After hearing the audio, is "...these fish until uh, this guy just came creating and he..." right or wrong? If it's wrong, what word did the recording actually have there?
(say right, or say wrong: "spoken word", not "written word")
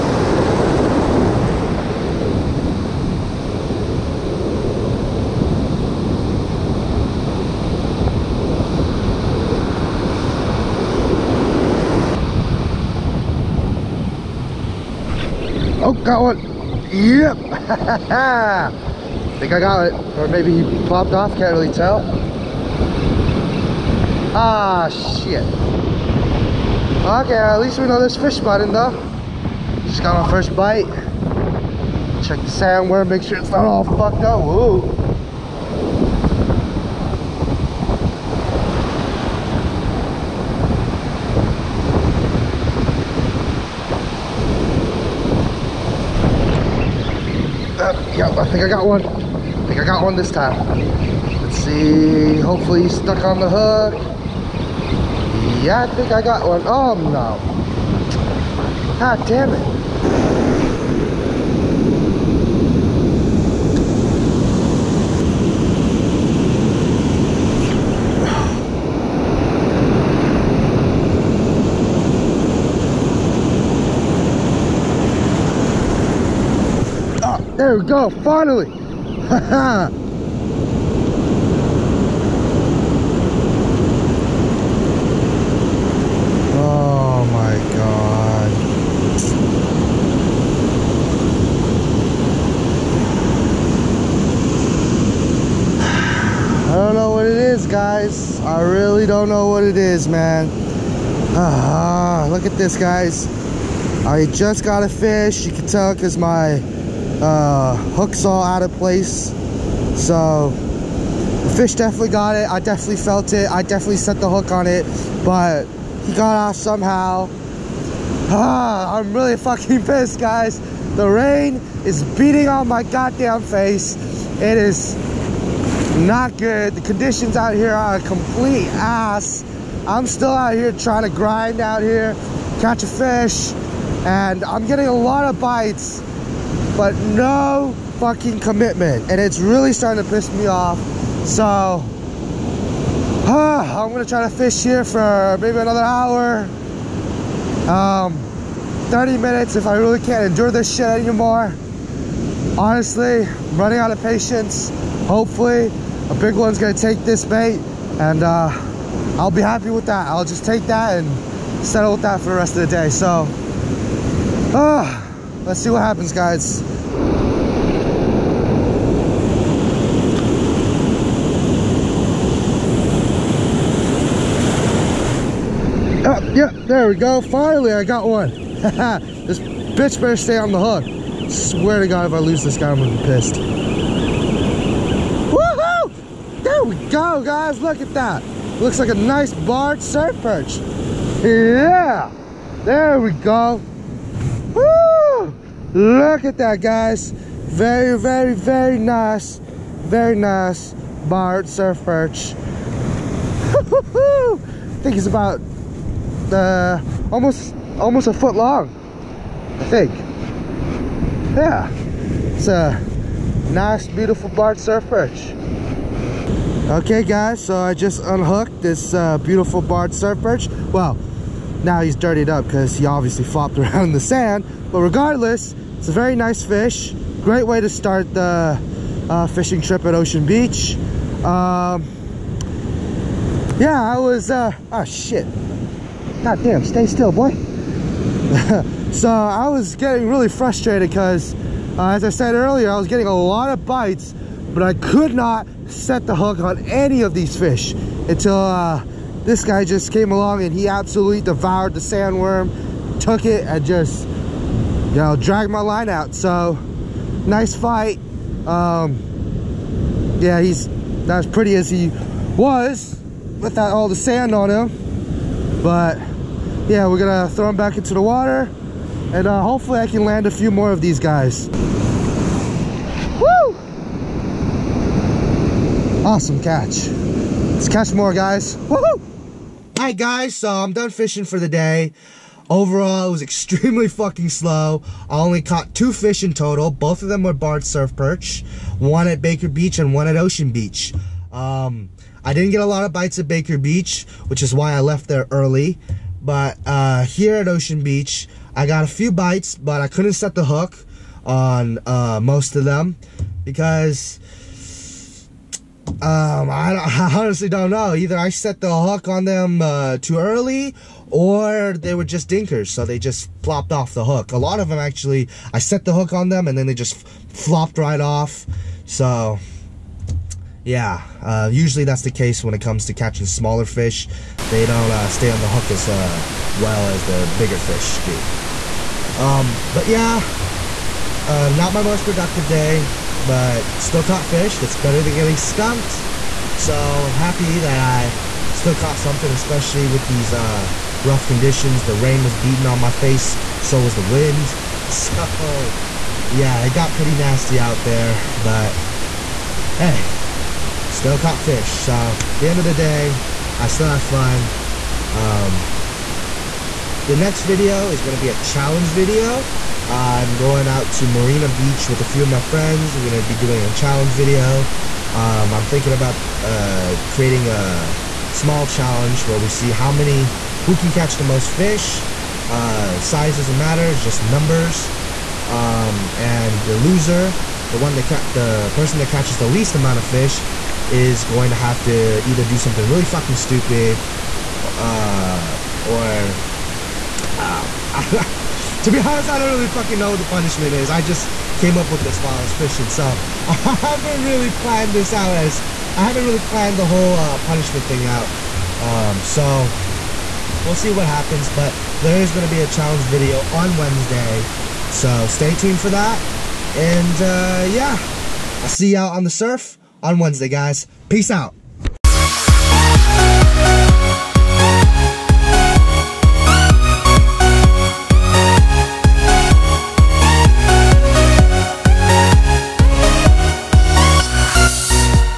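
wrong: "along", not "creating".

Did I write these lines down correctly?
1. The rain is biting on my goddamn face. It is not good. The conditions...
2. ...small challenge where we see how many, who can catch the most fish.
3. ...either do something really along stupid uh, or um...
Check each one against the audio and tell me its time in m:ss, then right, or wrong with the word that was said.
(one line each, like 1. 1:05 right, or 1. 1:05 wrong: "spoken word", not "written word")
1. 2:00 wrong: "beating", not "biting"
2. 6:08 right
3. 6:22 wrong: "fucking", not "along".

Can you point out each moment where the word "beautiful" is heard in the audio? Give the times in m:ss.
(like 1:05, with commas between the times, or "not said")
3:33, 3:39.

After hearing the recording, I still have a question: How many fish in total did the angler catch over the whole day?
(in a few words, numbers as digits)
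2.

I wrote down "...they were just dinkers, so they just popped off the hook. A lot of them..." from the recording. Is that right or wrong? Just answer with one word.
wrong.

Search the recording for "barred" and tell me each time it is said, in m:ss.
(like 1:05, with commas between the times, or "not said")
3:09, 3:21, 3:34, 3:39, 4:47.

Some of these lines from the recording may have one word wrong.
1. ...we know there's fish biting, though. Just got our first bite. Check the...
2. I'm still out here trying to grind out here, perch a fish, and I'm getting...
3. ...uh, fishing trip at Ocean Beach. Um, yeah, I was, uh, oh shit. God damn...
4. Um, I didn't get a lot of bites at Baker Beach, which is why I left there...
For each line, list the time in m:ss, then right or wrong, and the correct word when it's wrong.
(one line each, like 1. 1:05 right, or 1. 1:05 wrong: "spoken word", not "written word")
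1. 0:27 right
2. 2:09 wrong: "catch", not "perch"
3. 3:49 right
4. 4:51 right.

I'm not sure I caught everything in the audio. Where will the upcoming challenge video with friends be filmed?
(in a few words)
Marina Beach.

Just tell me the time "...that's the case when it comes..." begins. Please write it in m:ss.
5:21.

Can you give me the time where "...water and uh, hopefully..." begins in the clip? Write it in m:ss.
4:28.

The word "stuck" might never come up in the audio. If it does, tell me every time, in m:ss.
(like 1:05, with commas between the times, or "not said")
0:52.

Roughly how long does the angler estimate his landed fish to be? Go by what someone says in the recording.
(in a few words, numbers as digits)
Almost a foot.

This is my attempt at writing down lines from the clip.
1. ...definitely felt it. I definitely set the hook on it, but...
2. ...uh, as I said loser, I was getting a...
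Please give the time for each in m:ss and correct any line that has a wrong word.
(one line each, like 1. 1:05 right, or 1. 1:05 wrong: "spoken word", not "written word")
1. 1:52 right
2. 4:01 wrong: "earlier", not "loser".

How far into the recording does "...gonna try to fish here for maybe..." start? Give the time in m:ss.
2:23.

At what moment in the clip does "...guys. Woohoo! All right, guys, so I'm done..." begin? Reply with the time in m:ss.
4:38.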